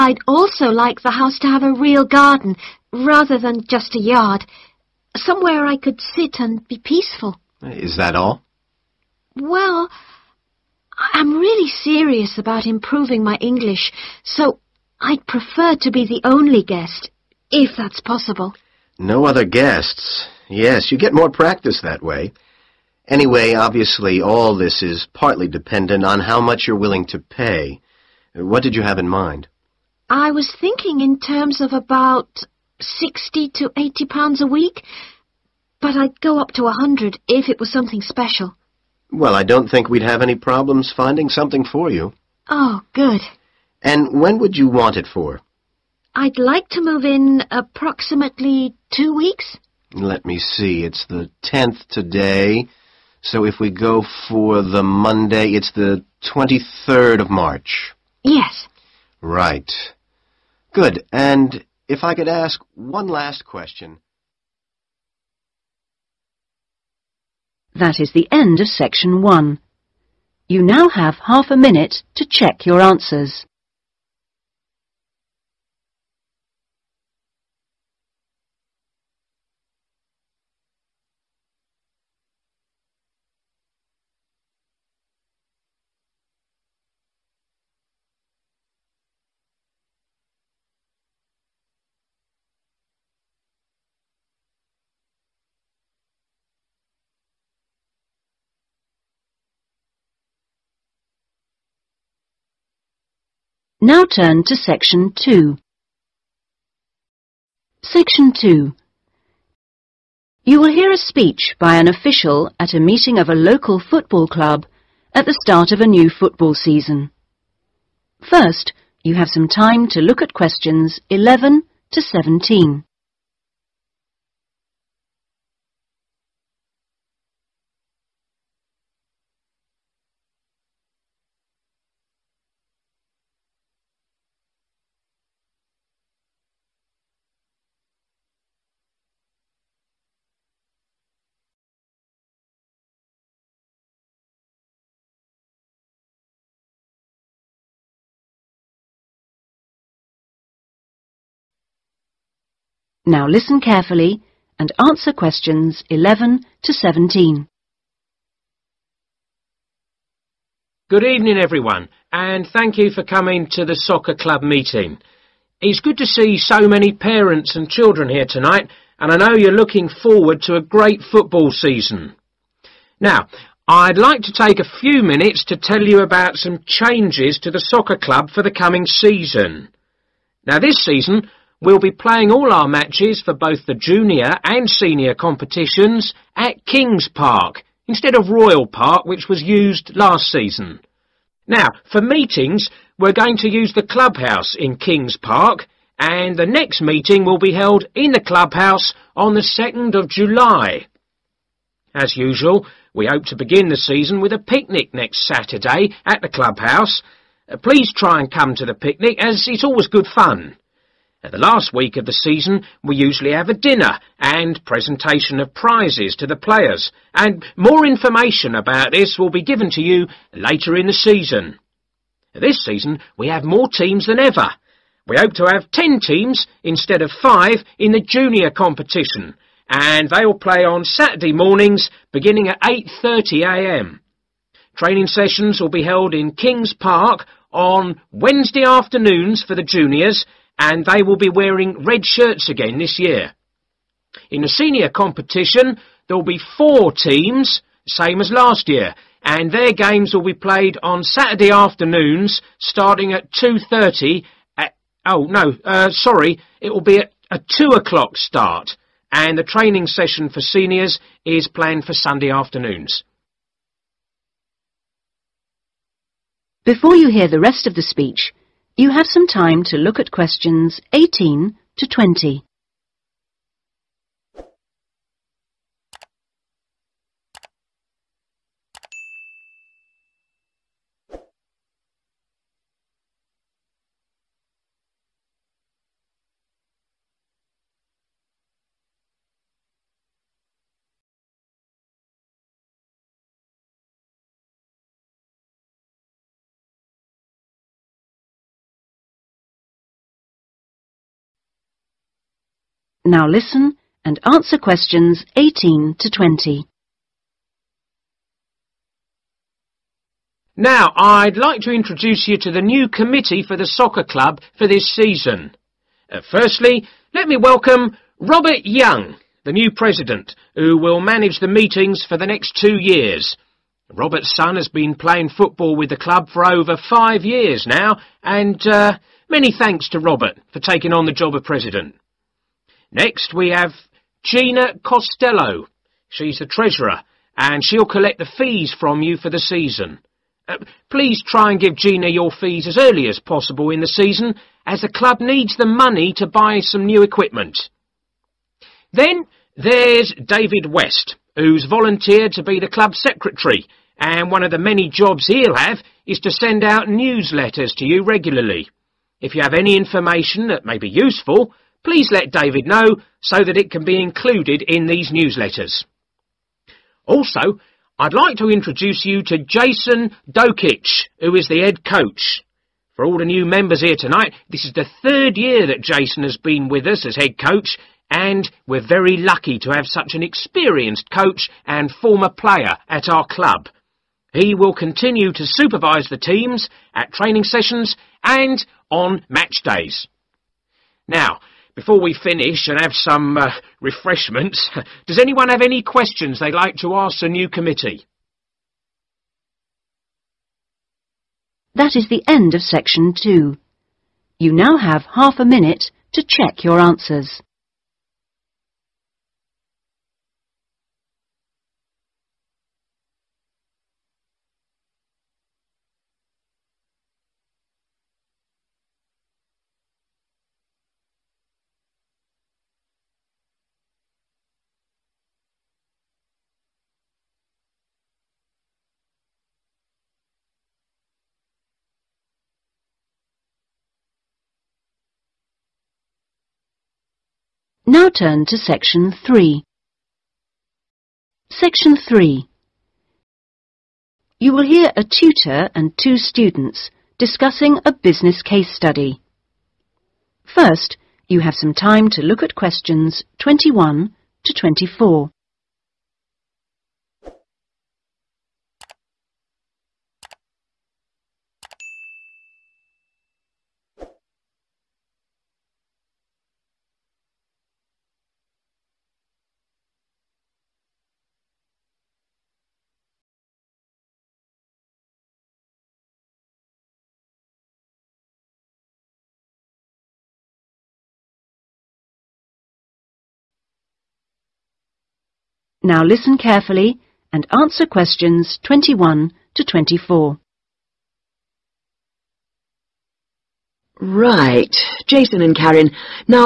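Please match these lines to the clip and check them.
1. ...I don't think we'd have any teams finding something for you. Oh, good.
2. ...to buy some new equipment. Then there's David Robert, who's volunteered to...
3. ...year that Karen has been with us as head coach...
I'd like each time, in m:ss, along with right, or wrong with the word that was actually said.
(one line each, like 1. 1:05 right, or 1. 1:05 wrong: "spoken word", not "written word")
1. 0:39 wrong: "problems", not "teams"
2. 5:46 wrong: "West", not "Robert"
3. 6:15 wrong: "Jason", not "Karen".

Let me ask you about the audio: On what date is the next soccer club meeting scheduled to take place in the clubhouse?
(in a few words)
2nd of July.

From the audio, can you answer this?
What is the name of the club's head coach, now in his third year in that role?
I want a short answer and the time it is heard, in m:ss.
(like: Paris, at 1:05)
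Jason Dokic, at 6:09.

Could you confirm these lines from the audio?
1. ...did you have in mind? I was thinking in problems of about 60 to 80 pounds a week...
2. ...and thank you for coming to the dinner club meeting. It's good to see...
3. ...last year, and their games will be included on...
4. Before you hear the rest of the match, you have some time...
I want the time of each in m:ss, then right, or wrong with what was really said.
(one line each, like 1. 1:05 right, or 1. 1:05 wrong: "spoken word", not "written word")
1. 0:28 wrong: "terms", not "problems"
2. 2:42 wrong: "soccer", not "dinner"
3. 4:08 wrong: "played", not "included"
4. 4:26 wrong: "speech", not "match".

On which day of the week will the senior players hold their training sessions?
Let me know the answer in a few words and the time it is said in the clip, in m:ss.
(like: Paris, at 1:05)
Sunday, at 4:21.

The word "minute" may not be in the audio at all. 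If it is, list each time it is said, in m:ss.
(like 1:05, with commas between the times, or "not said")
1:11, 2:55, 6:45.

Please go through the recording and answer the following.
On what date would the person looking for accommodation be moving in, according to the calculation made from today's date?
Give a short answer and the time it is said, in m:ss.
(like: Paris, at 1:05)
23rd of March, at 0:56.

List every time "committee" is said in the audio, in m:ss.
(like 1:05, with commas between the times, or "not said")
5:12, 6:37.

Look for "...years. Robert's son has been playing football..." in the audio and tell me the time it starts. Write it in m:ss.
5:22.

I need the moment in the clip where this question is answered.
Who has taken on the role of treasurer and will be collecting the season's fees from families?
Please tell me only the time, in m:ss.
5:34.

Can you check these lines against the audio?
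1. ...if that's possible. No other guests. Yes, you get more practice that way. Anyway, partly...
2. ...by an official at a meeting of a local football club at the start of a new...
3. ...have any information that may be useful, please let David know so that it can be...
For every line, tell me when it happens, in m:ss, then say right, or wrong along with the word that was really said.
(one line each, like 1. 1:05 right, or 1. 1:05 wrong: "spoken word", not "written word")
1. 0:17 wrong: "obviously", not "partly"
2. 1:51 right
3. 5:59 right.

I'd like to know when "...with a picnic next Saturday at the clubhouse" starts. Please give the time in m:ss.
3:24.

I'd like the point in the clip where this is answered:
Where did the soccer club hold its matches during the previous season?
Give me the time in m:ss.
3:08.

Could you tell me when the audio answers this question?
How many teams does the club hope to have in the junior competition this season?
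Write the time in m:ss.
3:45.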